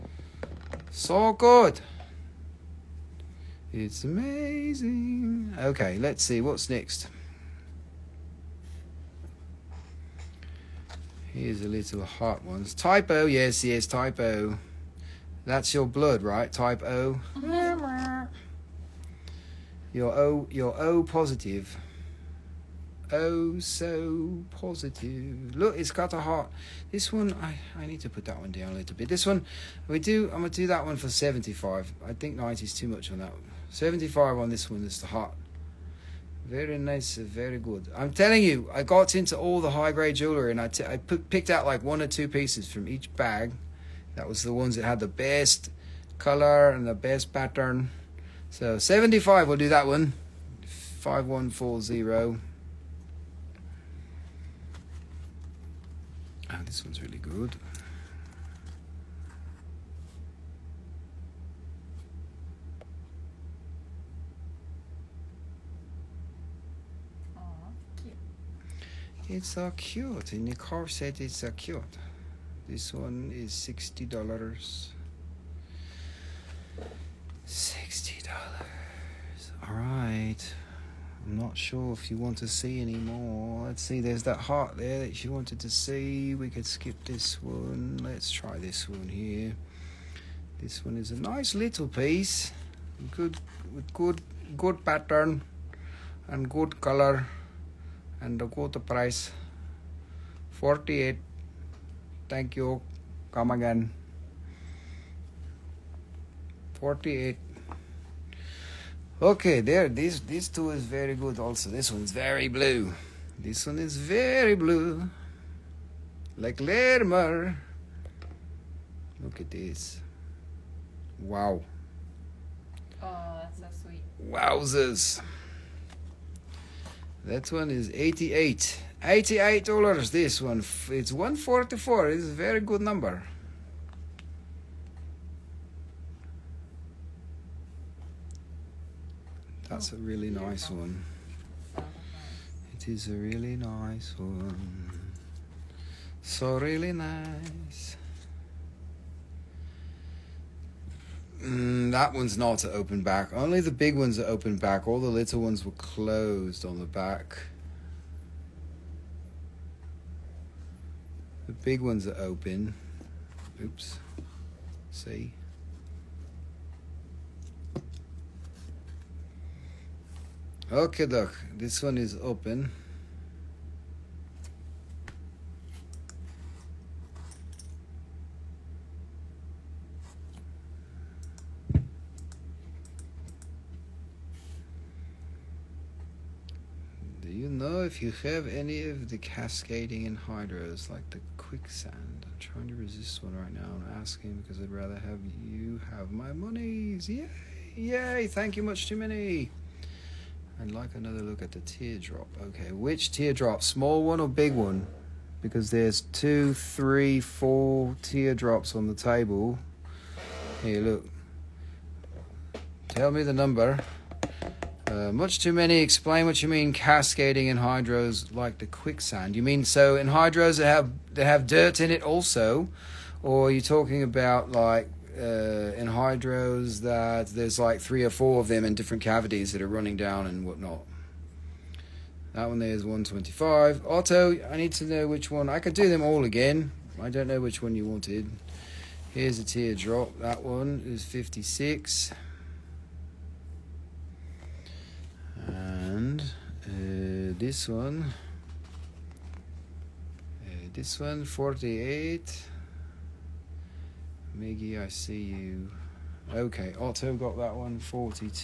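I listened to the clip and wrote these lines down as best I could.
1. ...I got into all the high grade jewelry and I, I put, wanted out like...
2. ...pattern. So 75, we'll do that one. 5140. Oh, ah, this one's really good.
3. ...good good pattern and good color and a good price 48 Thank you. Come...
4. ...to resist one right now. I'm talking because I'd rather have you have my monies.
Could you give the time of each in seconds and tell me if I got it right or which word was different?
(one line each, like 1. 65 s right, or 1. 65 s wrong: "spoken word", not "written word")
1. 38 s wrong: "picked", not "wanted"
2. 47 s right
3. 93 s right
4. 192 s wrong: "asking", not "talking".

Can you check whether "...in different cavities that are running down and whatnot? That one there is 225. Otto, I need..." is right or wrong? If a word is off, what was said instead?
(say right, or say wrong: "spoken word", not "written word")
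wrong: "125", not "225".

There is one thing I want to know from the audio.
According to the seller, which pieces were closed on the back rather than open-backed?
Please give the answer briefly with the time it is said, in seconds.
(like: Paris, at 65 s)
The little ones, at 154 s.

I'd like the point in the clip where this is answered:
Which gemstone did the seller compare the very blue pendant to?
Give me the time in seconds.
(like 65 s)
116 s.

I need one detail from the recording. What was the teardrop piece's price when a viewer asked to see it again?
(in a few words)
$56.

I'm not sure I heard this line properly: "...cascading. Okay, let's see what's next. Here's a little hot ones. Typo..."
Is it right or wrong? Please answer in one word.
wrong.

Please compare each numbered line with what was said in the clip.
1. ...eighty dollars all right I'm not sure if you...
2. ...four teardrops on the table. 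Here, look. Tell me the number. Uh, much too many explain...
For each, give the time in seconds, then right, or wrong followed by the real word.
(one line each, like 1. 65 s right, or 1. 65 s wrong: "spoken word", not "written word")
1. 77 s wrong: "sixty", not "eighty"
2. 207 s right.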